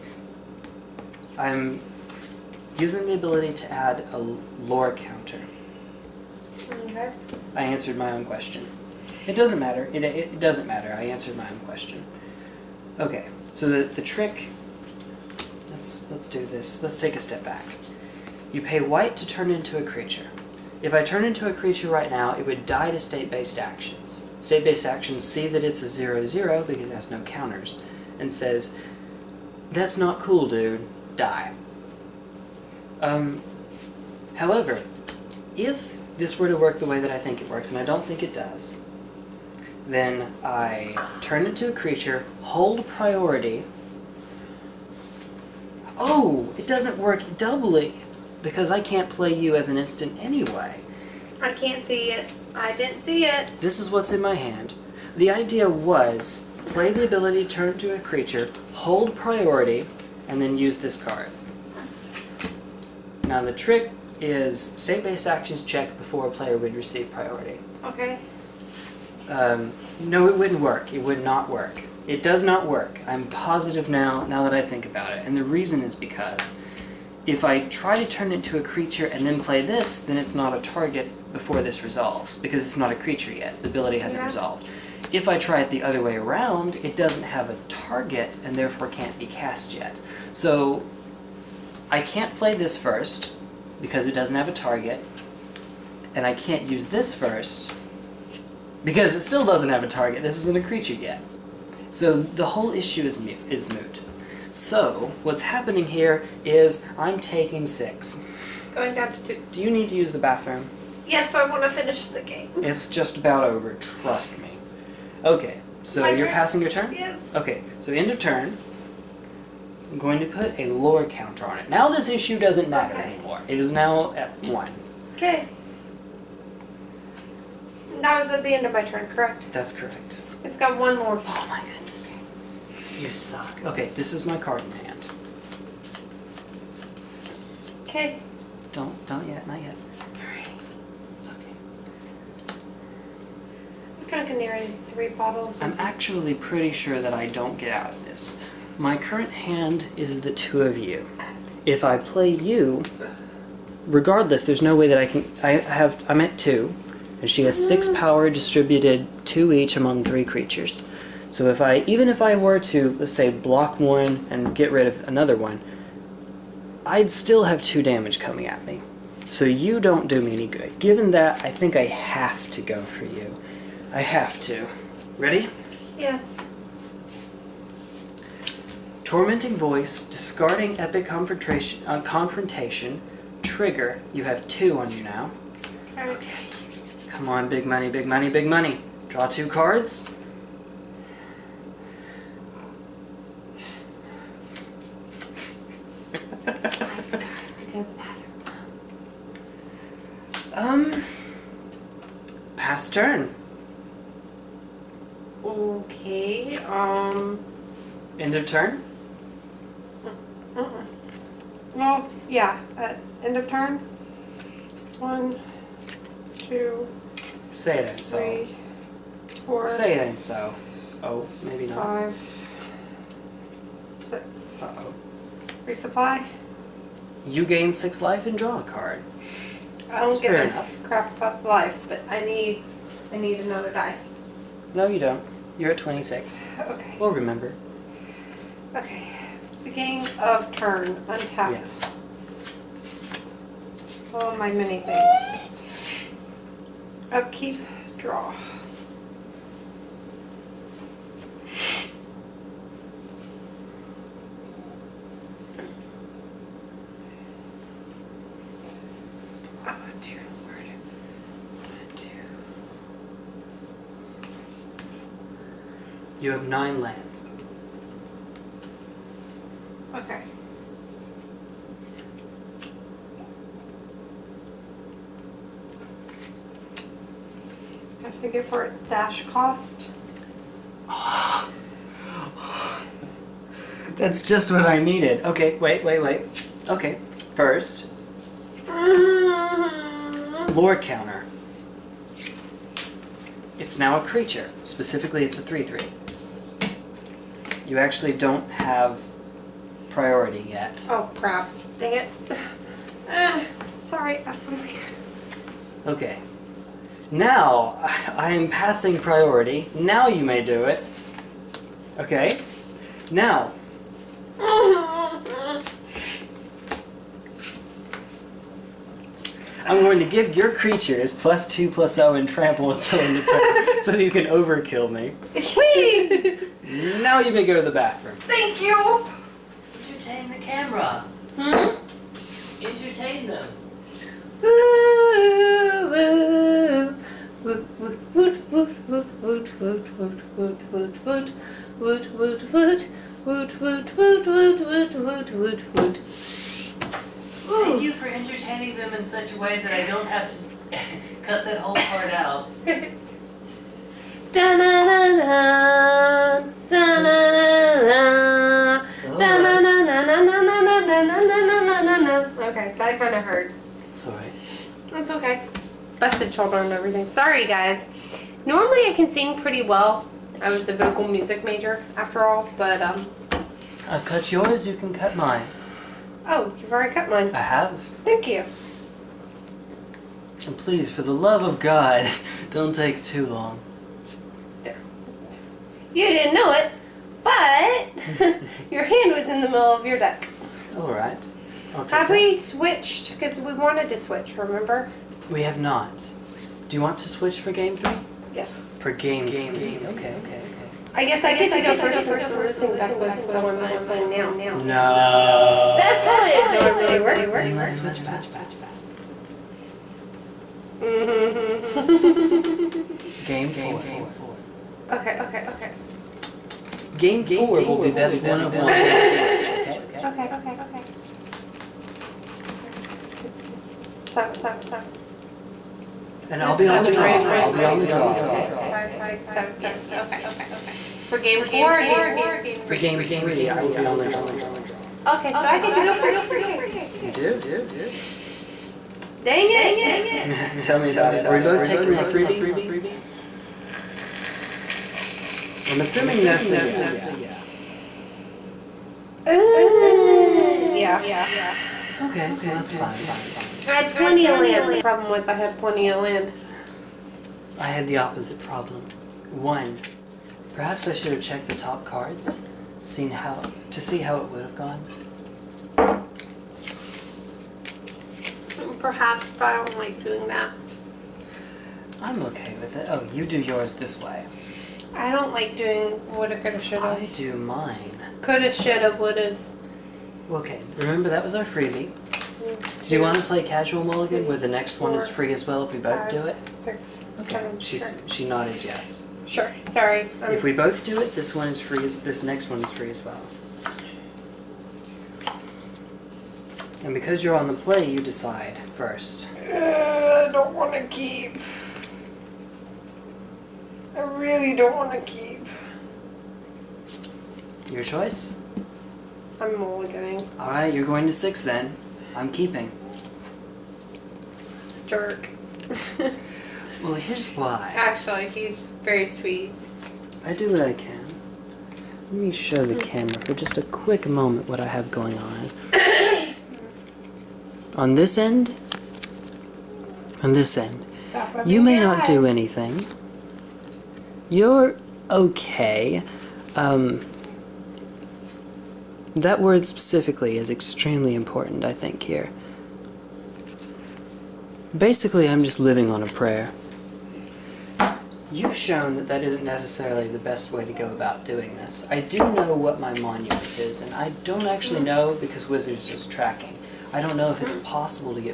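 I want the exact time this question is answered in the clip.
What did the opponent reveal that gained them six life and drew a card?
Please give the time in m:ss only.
3:45.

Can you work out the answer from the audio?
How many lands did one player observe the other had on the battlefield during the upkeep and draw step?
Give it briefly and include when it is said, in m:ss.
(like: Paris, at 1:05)
9, at 4:26.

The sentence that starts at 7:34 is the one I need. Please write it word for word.
The problem was I had plenty of land.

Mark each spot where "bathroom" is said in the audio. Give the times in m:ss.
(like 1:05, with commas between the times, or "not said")
1:50, 5:27.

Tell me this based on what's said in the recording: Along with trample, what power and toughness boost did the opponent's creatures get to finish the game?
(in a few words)
+2/+0.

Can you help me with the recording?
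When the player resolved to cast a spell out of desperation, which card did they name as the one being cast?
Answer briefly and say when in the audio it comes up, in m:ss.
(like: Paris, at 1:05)
Tormenting Voice, at 2:59.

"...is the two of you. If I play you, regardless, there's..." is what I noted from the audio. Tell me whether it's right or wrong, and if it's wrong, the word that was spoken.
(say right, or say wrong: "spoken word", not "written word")
right.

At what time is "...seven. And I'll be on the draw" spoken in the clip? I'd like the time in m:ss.
7:04.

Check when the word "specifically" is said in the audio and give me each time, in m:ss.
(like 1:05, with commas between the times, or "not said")
4:54, 8:59.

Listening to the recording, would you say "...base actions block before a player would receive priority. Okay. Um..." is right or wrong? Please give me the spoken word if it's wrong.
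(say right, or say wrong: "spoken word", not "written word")
wrong: "check", not "block".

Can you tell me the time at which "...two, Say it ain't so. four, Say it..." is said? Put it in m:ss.
3:36.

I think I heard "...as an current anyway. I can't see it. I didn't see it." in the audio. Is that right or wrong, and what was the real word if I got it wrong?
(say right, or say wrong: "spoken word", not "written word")
wrong: "instant", not "current".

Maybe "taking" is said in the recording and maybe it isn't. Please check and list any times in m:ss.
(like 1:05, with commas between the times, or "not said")
1:47, 7:21.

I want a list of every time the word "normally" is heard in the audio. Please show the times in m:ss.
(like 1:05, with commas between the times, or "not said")
6:08, 6:46.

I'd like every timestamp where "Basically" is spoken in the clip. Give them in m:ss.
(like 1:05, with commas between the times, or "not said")
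9:04.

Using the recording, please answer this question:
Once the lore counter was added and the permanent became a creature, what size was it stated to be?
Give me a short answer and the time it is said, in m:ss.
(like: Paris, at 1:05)
3/3, at 4:55.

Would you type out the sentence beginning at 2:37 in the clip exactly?
power distributed two each among three creatures.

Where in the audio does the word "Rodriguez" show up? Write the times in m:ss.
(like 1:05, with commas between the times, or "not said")
not said.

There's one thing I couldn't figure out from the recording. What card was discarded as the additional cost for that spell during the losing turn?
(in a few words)
Epic Confrontation.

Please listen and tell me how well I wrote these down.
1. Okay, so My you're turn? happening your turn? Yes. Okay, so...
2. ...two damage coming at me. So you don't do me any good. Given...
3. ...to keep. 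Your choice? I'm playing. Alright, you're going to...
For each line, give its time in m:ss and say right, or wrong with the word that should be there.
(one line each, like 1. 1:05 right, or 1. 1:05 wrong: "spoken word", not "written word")
1. 1:55 wrong: "passing", not "happening"
2. 2:47 right
3. 8:24 wrong: "mulliganing", not "playing".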